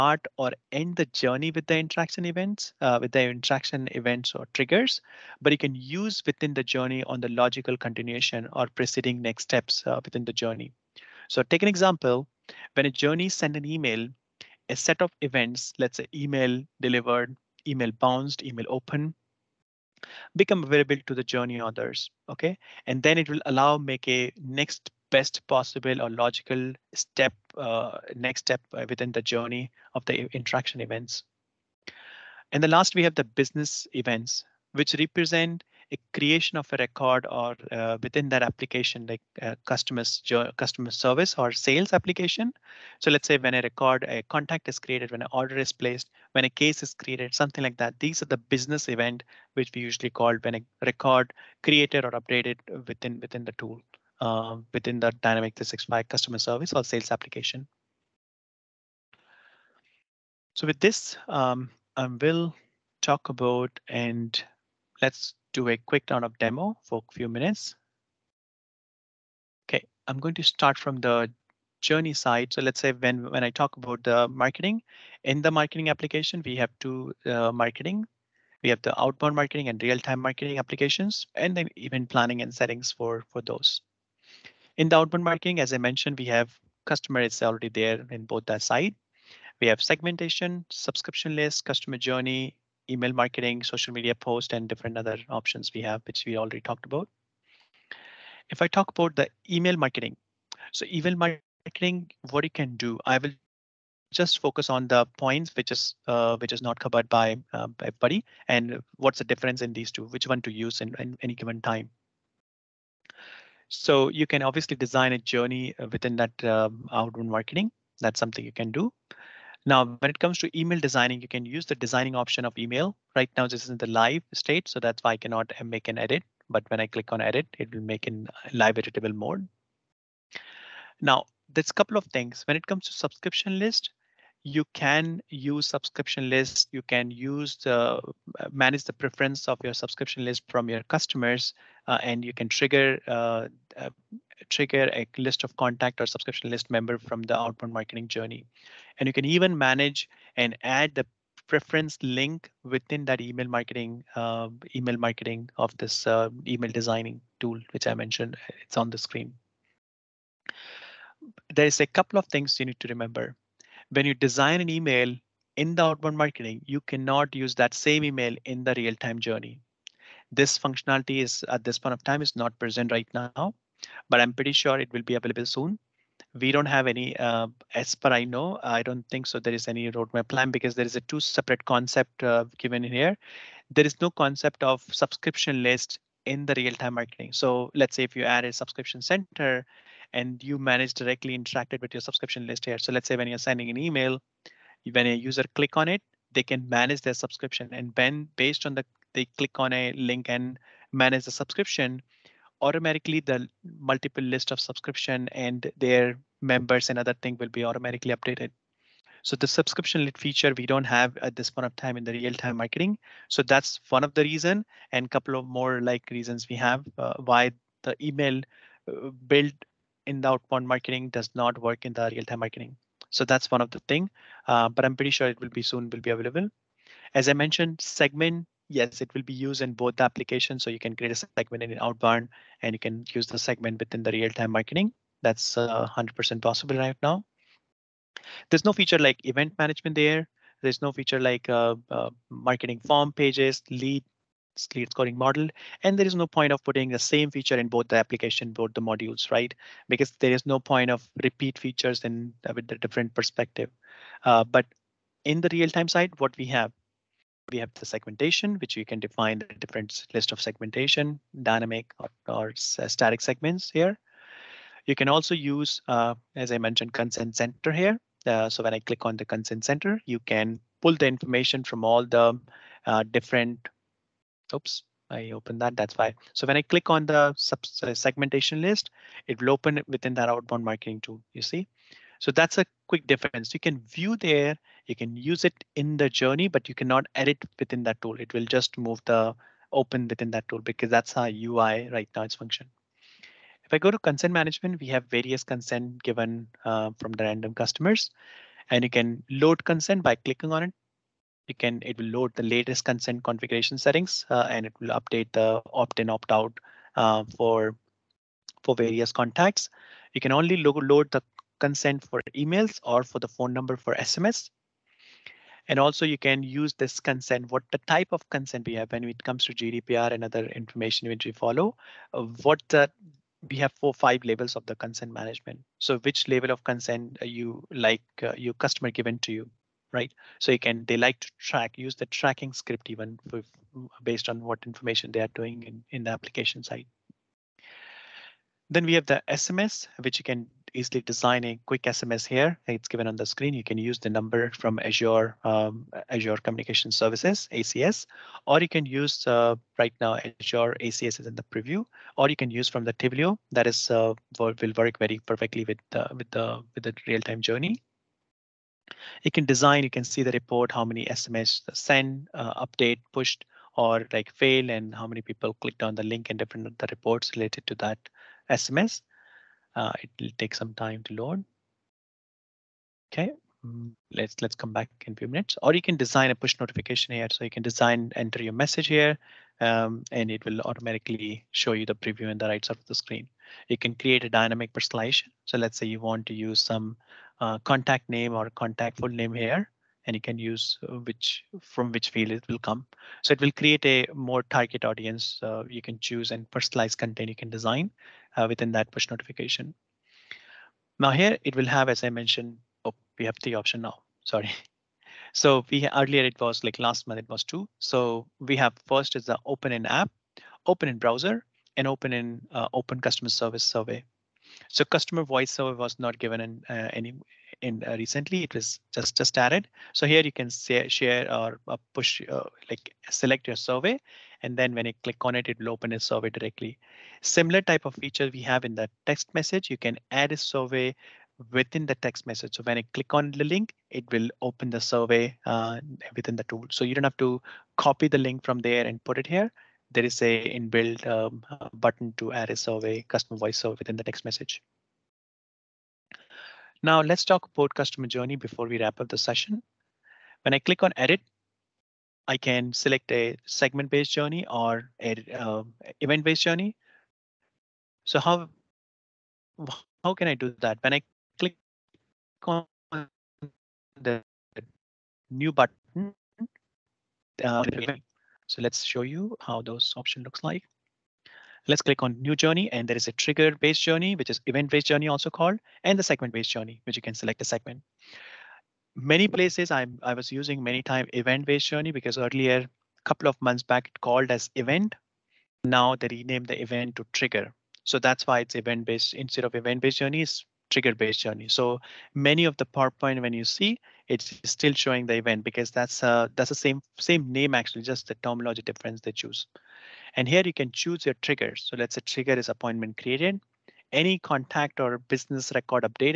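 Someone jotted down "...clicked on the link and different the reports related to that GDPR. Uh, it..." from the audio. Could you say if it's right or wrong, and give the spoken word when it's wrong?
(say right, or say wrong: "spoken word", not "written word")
wrong: "SMS", not "GDPR".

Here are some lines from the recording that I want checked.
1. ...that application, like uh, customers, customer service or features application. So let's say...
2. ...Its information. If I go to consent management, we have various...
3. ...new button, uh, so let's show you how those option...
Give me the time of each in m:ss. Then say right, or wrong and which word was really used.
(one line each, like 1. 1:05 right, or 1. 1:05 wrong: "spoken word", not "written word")
1. 0:38 wrong: "sales", not "features"
2. 4:52 wrong: "function", not "information"
3. 7:45 right.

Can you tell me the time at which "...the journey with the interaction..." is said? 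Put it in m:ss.
0:00.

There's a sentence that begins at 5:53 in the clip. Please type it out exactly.
That is uh, will work very perfectly with uh, with the with the real-time journey.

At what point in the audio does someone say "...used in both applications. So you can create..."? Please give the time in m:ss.
3:49.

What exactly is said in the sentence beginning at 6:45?
So we earlier it was like last month it was two.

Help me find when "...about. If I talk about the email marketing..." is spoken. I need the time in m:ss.
1:36.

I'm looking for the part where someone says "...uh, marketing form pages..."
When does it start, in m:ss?
4:01.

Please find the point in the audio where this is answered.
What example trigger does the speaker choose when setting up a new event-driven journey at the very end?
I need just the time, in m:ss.
8:22.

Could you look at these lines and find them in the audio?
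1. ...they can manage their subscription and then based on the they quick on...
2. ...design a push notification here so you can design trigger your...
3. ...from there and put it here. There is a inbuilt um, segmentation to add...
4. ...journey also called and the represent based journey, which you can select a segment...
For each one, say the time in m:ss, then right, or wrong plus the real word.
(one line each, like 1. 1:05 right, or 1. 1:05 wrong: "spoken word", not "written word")
1. 3:16 wrong: "click", not "quick"
2. 6:15 wrong: "enter", not "trigger"
3. 7:18 wrong: "button", not "segmentation"
4. 7:54 wrong: "segment", not "represent".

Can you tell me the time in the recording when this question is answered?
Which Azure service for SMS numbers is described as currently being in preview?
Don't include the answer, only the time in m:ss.
5:50.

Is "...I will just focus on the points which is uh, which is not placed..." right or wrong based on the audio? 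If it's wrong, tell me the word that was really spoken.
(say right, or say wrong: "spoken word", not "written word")
wrong: "covered", not "placed".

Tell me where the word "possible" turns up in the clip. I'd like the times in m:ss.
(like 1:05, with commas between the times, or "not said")
0:25, 3:56.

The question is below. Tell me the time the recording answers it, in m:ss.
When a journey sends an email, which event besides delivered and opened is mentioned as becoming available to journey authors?
0:17.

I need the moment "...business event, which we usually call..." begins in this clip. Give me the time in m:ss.
0:48.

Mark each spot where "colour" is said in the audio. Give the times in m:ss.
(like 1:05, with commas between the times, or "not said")
not said.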